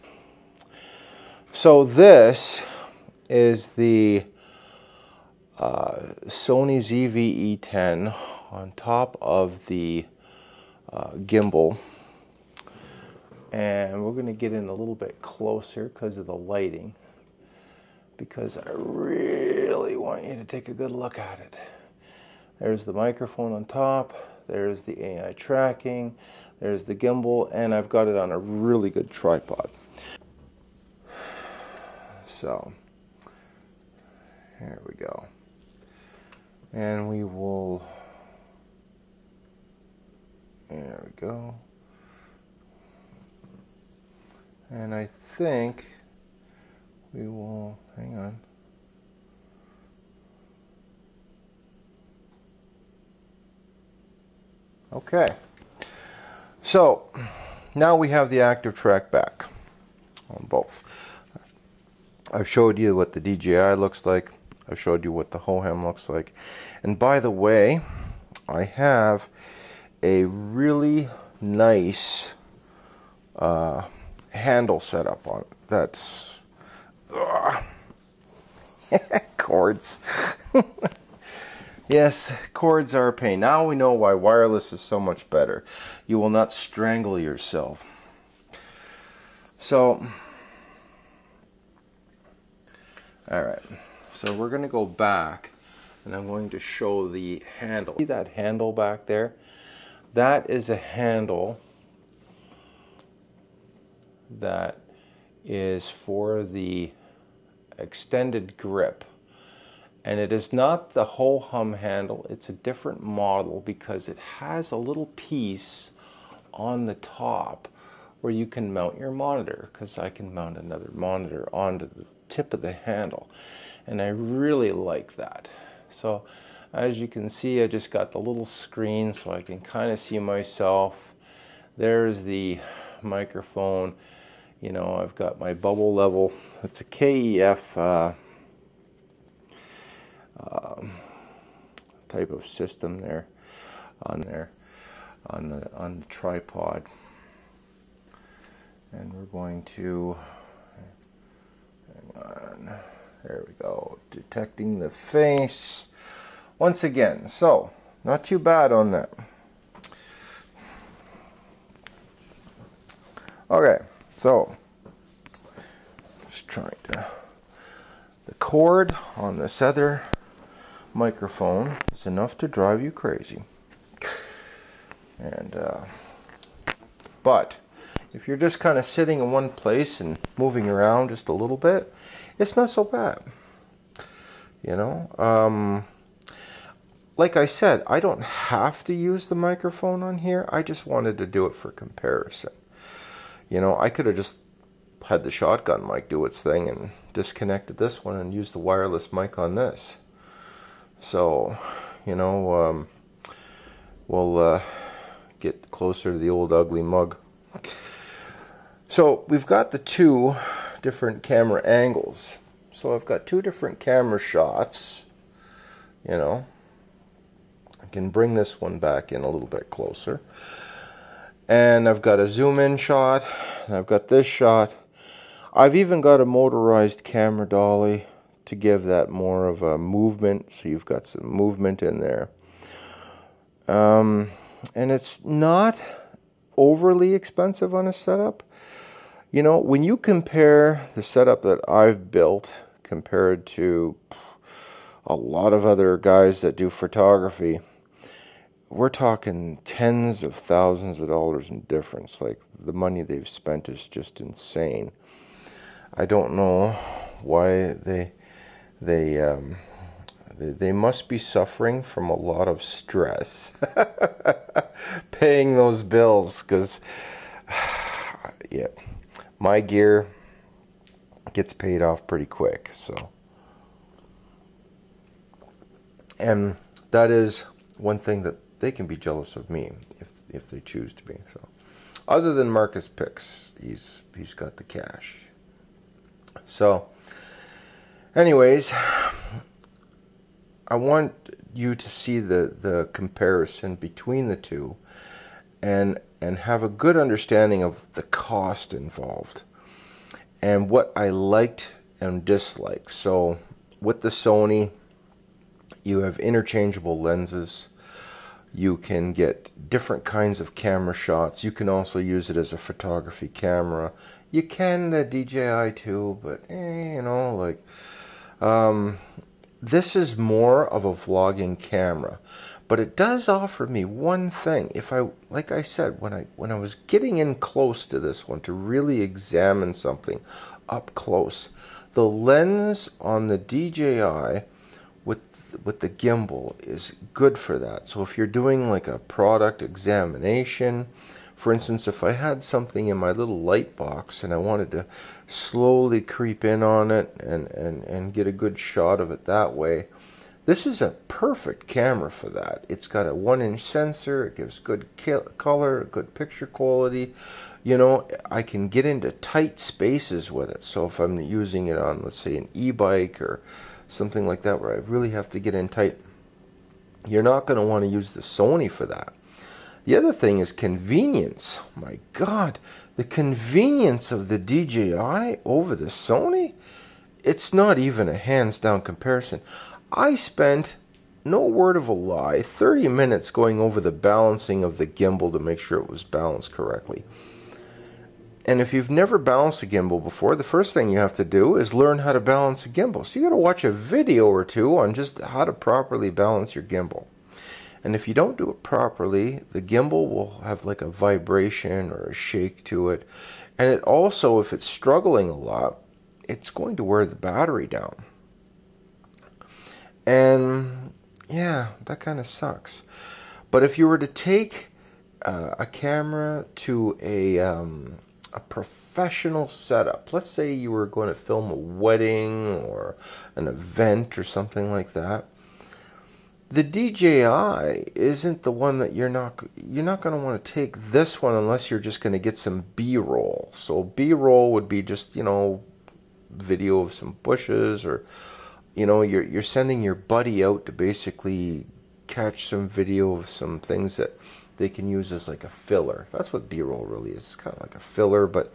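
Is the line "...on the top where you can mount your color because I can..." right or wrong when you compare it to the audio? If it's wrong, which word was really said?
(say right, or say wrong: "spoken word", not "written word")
wrong: "monitor", not "color".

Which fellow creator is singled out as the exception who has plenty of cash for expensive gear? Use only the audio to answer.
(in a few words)
Marcus Pix.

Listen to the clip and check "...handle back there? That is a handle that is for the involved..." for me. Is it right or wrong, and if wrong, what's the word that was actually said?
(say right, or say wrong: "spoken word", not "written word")
wrong: "extended", not "involved".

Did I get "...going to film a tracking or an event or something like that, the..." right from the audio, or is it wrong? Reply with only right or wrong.
wrong.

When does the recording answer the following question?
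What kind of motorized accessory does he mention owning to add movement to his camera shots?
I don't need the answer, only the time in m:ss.
3:46.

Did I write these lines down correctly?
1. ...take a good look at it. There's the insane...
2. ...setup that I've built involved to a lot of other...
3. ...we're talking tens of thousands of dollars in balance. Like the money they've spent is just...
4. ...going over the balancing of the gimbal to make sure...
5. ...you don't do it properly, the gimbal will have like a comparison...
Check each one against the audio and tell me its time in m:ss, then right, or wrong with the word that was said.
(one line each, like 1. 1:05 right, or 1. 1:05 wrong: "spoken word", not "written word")
1. 0:20 wrong: "microphone", not "insane"
2. 4:01 wrong: "compared", not "involved"
3. 4:08 wrong: "difference", not "balance"
4. 6:23 right
5. 6:38 wrong: "vibration", not "comparison".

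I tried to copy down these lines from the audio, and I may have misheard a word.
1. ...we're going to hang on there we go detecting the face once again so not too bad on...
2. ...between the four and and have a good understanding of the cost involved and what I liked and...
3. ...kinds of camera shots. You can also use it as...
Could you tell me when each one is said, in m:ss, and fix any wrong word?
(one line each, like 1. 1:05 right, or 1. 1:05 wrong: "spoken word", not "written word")
1. 2:29 right
2. 4:53 wrong: "two", not "four"
3. 5:10 right.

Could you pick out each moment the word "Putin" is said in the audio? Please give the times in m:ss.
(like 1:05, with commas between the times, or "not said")
not said.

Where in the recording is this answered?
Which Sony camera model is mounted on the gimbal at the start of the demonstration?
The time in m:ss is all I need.
0:06.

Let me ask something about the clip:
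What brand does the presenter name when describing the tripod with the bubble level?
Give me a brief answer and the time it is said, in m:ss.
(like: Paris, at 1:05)
KEF, at 2:16.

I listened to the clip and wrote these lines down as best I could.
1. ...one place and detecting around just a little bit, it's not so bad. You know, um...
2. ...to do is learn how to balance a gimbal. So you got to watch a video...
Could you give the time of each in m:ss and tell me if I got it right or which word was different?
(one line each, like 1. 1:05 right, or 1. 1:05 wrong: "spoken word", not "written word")
1. 2:59 wrong: "moving", not "detecting"
2. 6:31 right.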